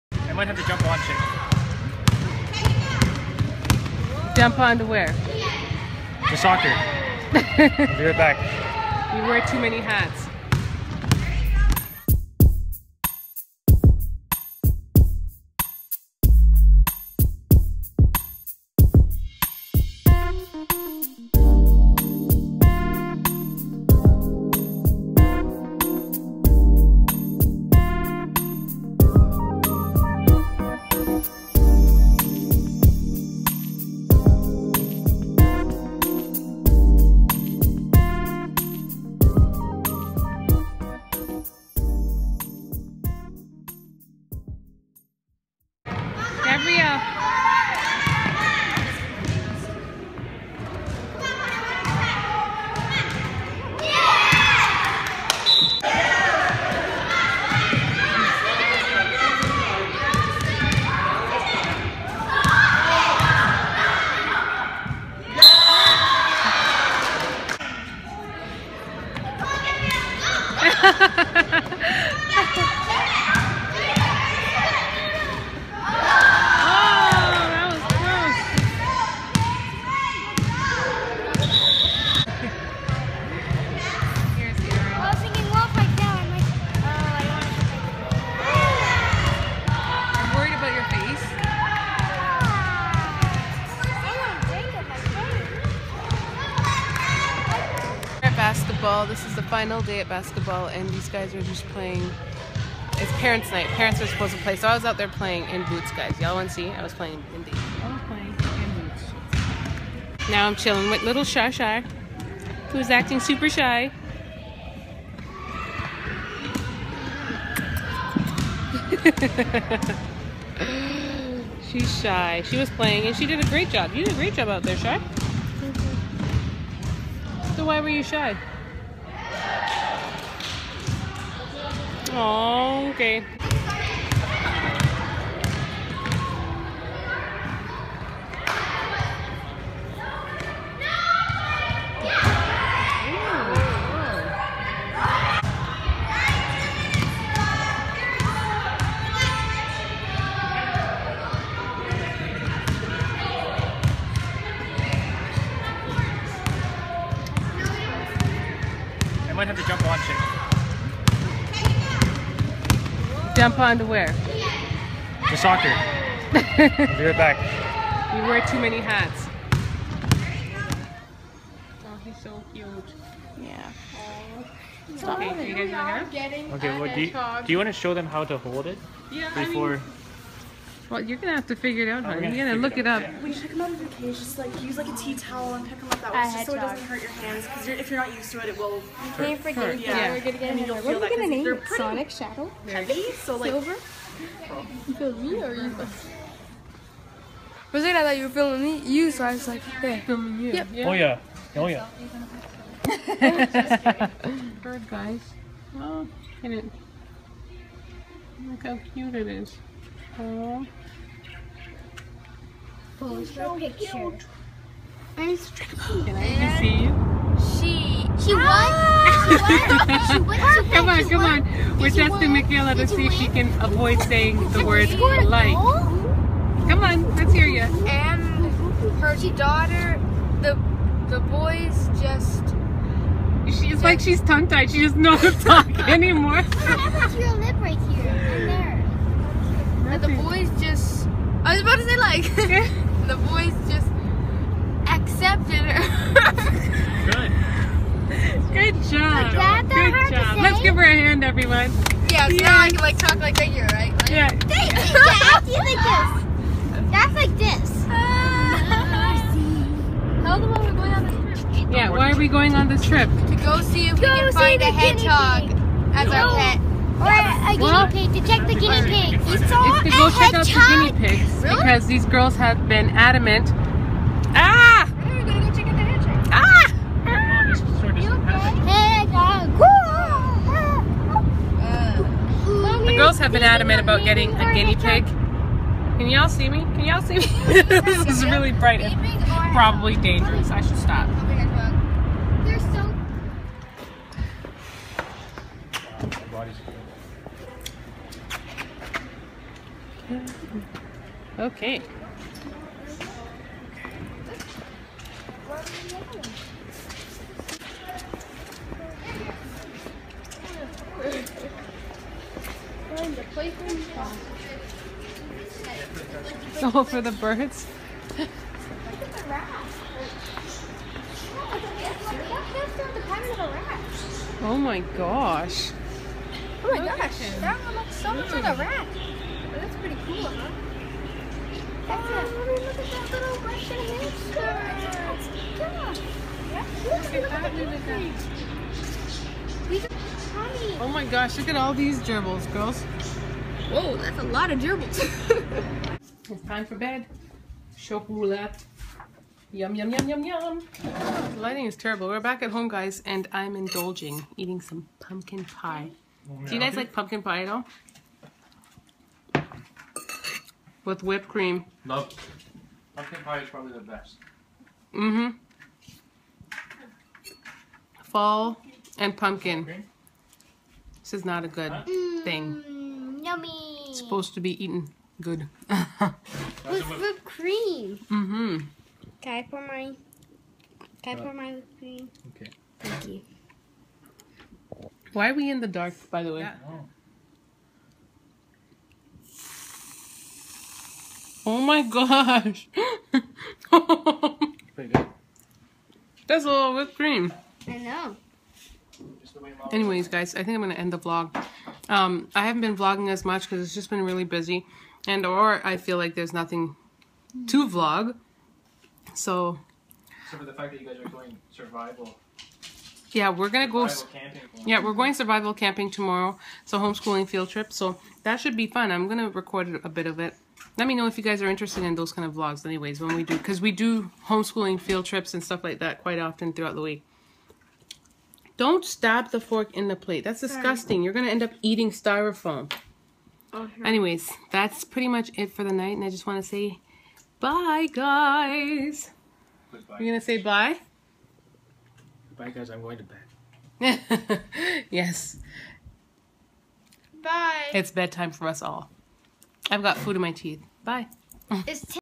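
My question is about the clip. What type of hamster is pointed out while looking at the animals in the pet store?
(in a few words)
Russian hamster.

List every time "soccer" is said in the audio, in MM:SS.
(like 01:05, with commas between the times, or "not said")
00:06, 02:45.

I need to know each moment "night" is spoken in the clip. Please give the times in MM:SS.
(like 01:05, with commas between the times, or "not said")
01:43, 07:15.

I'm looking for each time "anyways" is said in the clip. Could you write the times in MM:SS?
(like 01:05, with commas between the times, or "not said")
06:39, 07:02, 07:13.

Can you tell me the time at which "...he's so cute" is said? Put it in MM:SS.
02:52.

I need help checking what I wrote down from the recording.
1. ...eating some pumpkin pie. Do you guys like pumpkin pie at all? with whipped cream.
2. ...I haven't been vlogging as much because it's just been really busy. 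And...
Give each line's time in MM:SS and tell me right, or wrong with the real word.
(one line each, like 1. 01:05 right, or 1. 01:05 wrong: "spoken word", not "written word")
1. 05:54 right
2. 06:42 right.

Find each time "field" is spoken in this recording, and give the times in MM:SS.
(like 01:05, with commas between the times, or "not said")
06:57, 07:04.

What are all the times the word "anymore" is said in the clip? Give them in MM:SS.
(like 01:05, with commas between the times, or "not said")
03:55.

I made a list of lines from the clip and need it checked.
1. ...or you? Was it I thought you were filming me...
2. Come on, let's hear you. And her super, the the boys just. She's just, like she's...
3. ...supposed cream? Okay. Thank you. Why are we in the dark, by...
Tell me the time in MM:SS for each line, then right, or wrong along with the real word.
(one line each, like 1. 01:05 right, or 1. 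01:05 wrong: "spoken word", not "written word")
1. 03:15 right
2. 03:46 wrong: "daughter", not "super"
3. 06:21 wrong: "whipped", not "supposed".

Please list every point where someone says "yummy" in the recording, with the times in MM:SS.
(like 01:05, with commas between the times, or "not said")
06:13.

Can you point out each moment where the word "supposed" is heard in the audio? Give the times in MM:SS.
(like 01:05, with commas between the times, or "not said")
01:44, 06:13.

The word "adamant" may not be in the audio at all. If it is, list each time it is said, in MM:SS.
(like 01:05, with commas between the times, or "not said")
04:32, 04:43.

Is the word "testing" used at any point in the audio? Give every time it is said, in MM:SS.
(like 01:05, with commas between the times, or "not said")
03:41.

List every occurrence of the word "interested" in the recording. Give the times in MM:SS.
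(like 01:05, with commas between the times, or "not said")
07:01.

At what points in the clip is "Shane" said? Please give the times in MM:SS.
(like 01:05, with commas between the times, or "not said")
00:04, 02:43.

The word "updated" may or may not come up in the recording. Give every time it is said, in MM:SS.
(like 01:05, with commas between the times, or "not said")
not said.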